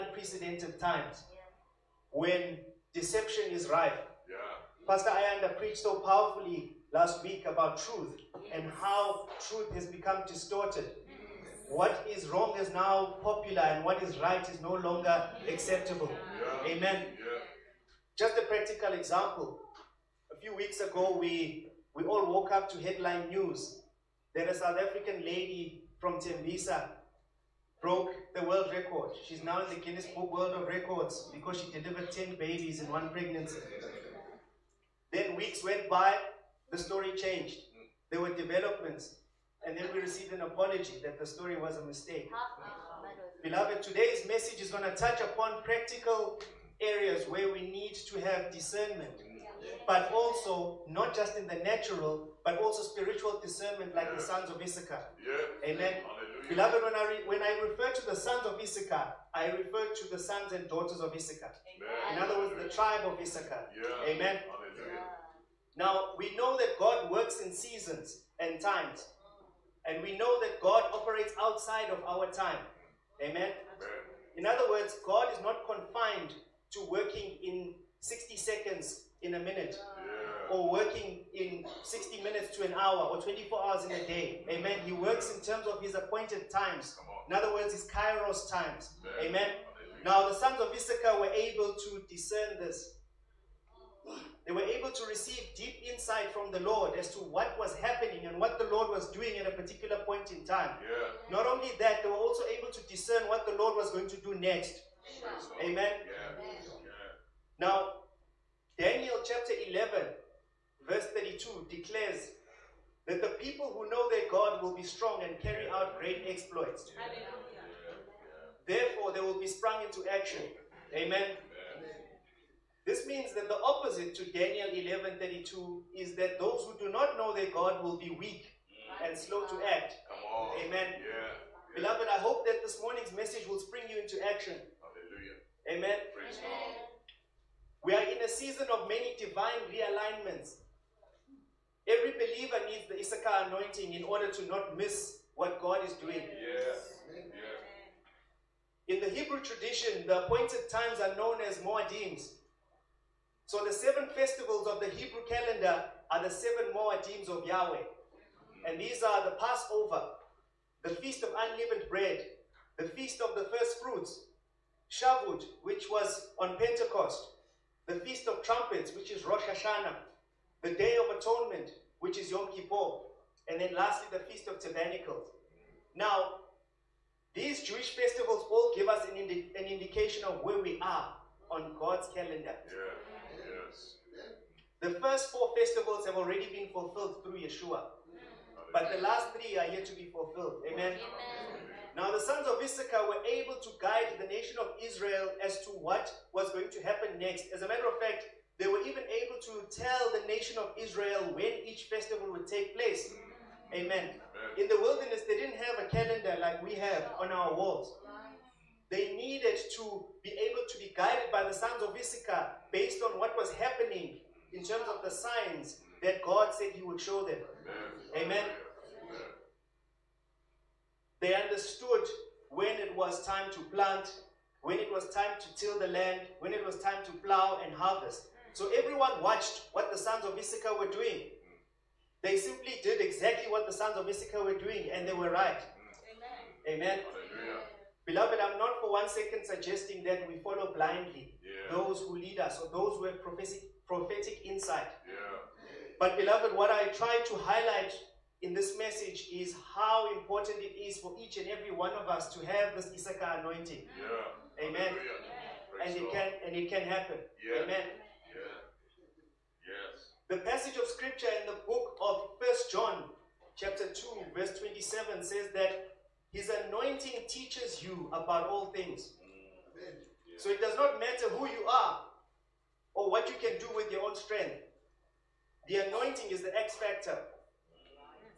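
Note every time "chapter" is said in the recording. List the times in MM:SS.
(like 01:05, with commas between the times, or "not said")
01:49, 04:23.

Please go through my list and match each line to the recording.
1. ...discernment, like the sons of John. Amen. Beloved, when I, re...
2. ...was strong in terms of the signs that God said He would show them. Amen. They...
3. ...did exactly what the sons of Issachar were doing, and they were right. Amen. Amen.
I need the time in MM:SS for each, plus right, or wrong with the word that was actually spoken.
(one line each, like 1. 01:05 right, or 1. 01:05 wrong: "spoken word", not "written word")
1. 00:53 wrong: "Issachar", not "John"
2. 03:33 wrong: "happening", not "strong"
3. 03:52 right.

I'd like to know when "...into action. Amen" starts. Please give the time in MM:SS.
01:59.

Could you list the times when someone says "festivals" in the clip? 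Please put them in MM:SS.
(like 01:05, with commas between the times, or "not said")
02:34, 02:57, 03:05, 03:21.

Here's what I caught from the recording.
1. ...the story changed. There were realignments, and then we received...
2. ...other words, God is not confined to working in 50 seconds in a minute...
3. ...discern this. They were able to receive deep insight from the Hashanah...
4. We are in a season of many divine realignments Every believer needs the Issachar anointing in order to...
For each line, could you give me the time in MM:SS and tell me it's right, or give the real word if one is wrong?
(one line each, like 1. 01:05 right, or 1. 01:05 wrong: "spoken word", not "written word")
1. 00:36 wrong: "developments", not "realignments"
2. 01:14 wrong: "60", not "50"
3. 01:32 wrong: "Lord", not "Hashanah"
4. 02:17 right.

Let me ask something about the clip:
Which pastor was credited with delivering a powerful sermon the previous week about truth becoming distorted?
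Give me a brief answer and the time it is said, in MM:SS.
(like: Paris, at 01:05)
Pastor Ayanda, at 00:04.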